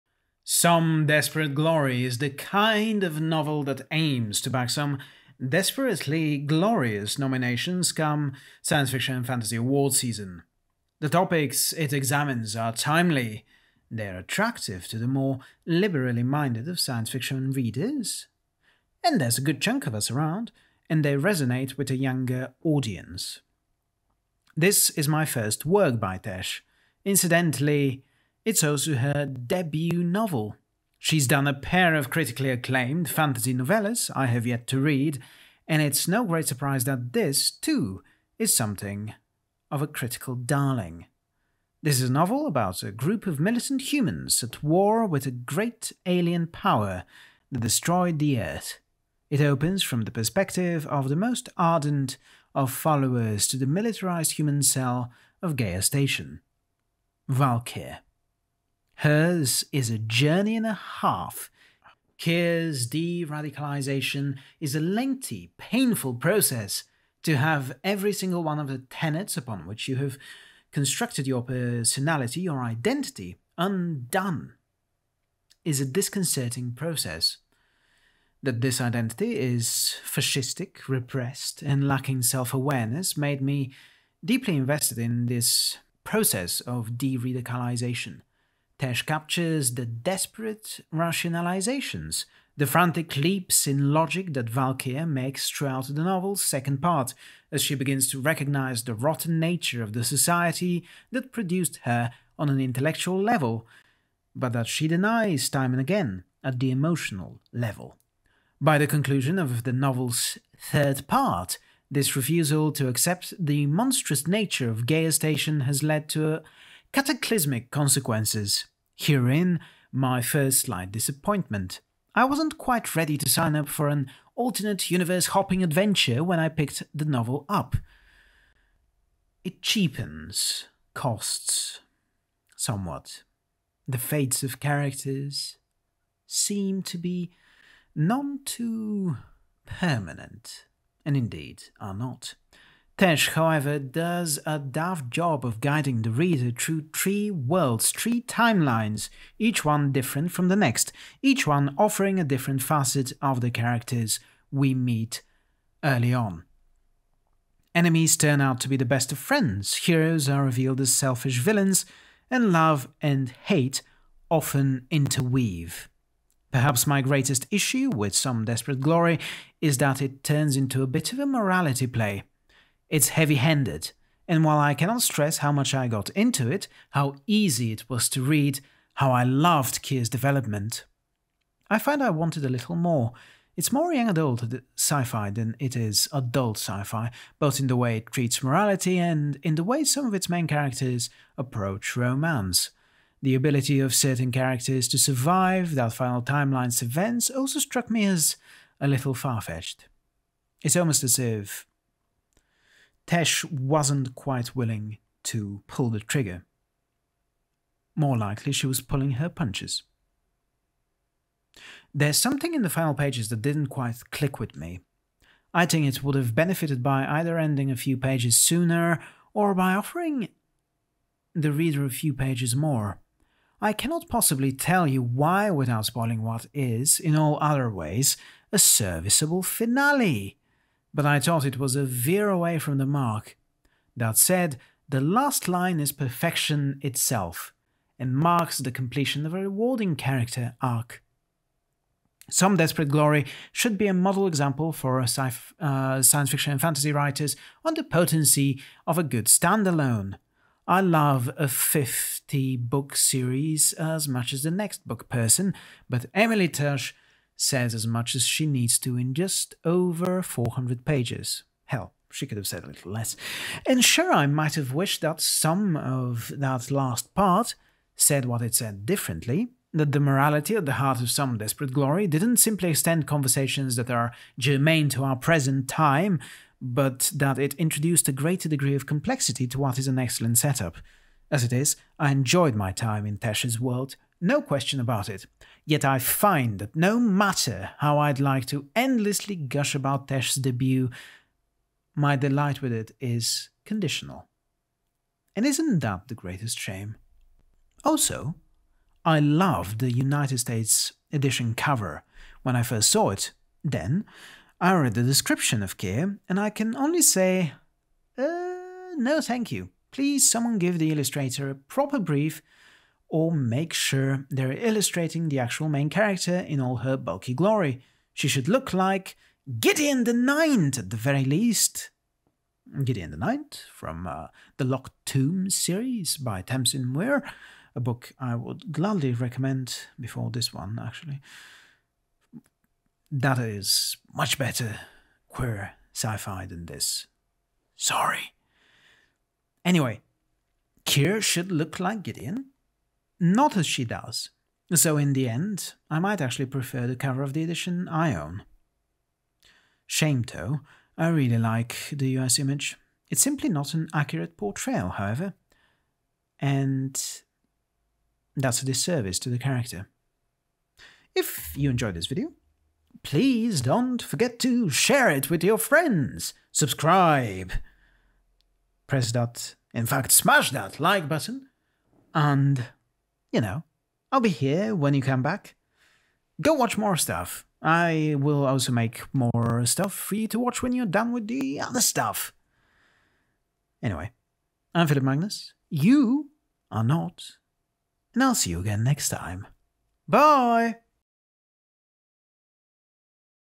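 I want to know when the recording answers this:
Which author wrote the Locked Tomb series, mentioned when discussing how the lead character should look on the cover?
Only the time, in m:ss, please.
5:26.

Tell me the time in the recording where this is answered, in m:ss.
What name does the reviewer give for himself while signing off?
6:24.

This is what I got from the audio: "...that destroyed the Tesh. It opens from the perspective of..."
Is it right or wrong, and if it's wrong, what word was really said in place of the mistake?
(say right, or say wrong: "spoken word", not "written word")
wrong: "Earth", not "Tesh".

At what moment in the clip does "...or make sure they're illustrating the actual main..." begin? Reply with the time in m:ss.
5:13.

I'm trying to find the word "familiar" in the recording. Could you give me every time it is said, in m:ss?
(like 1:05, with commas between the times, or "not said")
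not said.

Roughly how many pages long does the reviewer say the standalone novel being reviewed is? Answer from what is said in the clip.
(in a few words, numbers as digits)
just over 400.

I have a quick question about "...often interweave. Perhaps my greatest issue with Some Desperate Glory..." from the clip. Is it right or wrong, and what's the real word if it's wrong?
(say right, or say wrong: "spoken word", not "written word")
right.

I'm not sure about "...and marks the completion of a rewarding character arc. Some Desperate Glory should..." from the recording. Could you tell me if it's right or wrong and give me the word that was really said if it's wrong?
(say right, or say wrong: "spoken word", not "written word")
right.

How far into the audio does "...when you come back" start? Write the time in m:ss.
6:14.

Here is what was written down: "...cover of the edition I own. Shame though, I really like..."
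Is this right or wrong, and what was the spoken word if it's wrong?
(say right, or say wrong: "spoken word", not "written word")
right.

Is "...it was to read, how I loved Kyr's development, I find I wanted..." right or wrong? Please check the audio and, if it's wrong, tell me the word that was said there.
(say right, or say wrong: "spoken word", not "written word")
right.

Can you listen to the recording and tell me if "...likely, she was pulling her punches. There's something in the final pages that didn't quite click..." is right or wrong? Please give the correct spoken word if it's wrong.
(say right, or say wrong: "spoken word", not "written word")
right.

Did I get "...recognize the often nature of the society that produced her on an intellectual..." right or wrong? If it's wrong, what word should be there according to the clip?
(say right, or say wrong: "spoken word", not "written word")
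wrong: "rotten", not "often".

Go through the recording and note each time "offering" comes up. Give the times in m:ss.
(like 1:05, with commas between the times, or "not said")
2:31, 3:39.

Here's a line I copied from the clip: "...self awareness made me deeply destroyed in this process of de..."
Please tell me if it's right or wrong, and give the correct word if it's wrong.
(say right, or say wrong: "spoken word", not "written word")
wrong: "invested", not "destroyed".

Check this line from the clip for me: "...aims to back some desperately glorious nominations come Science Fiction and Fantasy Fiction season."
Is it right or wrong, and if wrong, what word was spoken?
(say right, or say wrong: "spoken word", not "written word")
wrong: "Award", not "Fiction".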